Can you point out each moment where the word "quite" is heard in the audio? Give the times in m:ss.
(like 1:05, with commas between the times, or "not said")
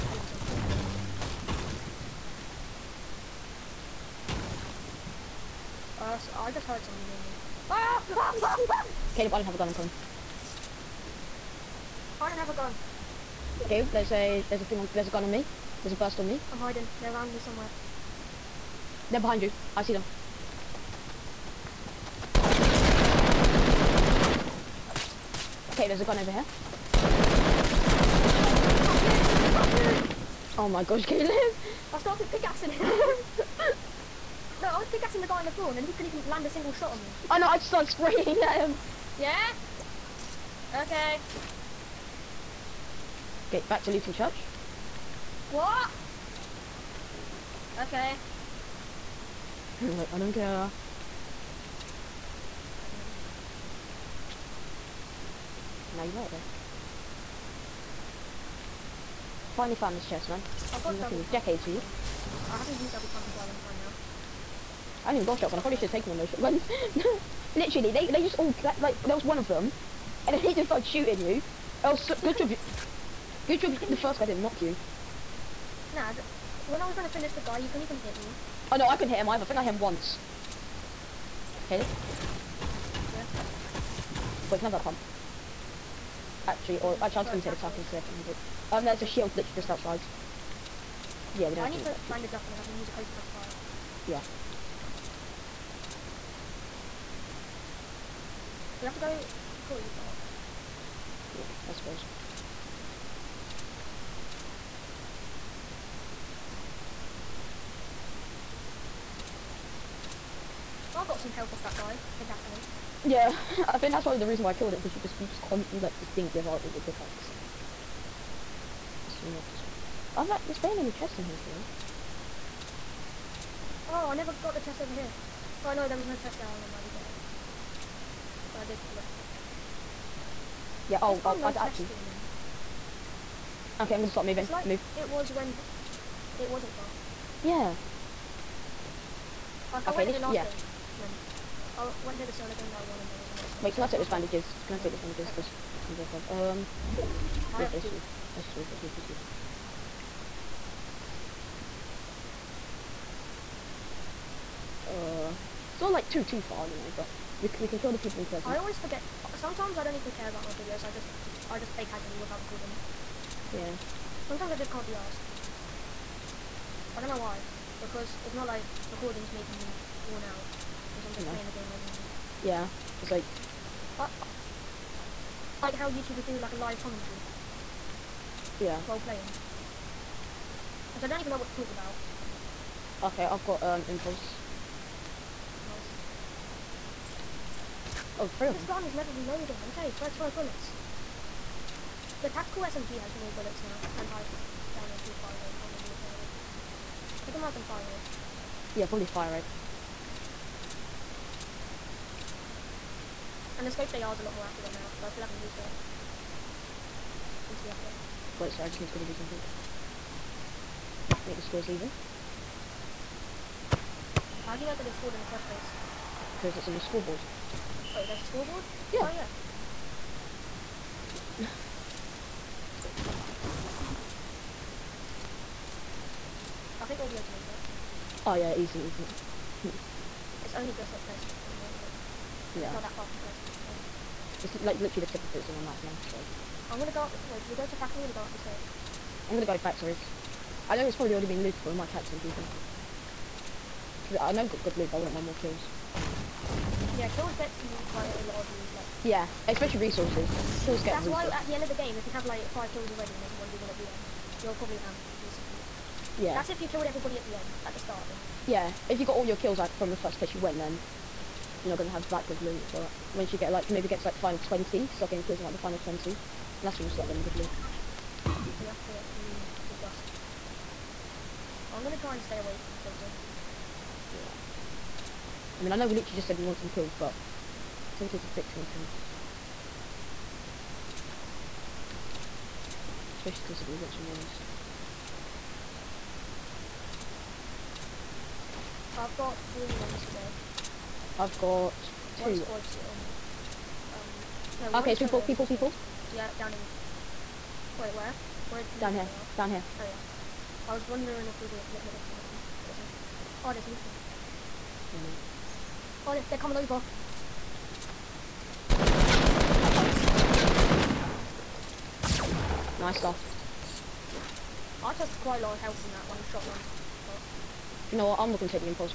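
1:03, 4:07, 5:15.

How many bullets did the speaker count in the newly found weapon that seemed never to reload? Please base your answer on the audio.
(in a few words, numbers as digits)
35.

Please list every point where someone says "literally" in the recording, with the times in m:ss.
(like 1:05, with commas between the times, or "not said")
1:07, 1:29, 3:54, 4:35.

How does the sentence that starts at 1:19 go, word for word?
I think I hit him once.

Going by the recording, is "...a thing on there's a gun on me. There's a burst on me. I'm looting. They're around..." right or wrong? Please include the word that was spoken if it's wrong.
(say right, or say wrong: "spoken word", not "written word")
wrong: "hiding", not "looting".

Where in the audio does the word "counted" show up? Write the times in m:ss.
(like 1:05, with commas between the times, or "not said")
not said.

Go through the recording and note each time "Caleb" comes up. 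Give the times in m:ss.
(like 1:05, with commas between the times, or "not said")
0:09, 0:13, 0:31.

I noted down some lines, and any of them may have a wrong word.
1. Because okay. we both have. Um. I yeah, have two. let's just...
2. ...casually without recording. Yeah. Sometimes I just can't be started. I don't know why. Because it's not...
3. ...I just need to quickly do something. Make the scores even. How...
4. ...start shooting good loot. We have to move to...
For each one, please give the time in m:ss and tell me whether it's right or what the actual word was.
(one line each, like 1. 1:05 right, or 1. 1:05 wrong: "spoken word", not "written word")
1. 2:25 right
2. 2:41 wrong: "asked", not "started"
3. 3:28 right
4. 4:26 wrong: "getting", not "shooting".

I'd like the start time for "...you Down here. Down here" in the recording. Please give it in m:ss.
4:58.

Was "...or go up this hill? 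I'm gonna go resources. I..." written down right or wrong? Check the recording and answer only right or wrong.
wrong.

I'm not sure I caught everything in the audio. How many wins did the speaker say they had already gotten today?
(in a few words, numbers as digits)
3.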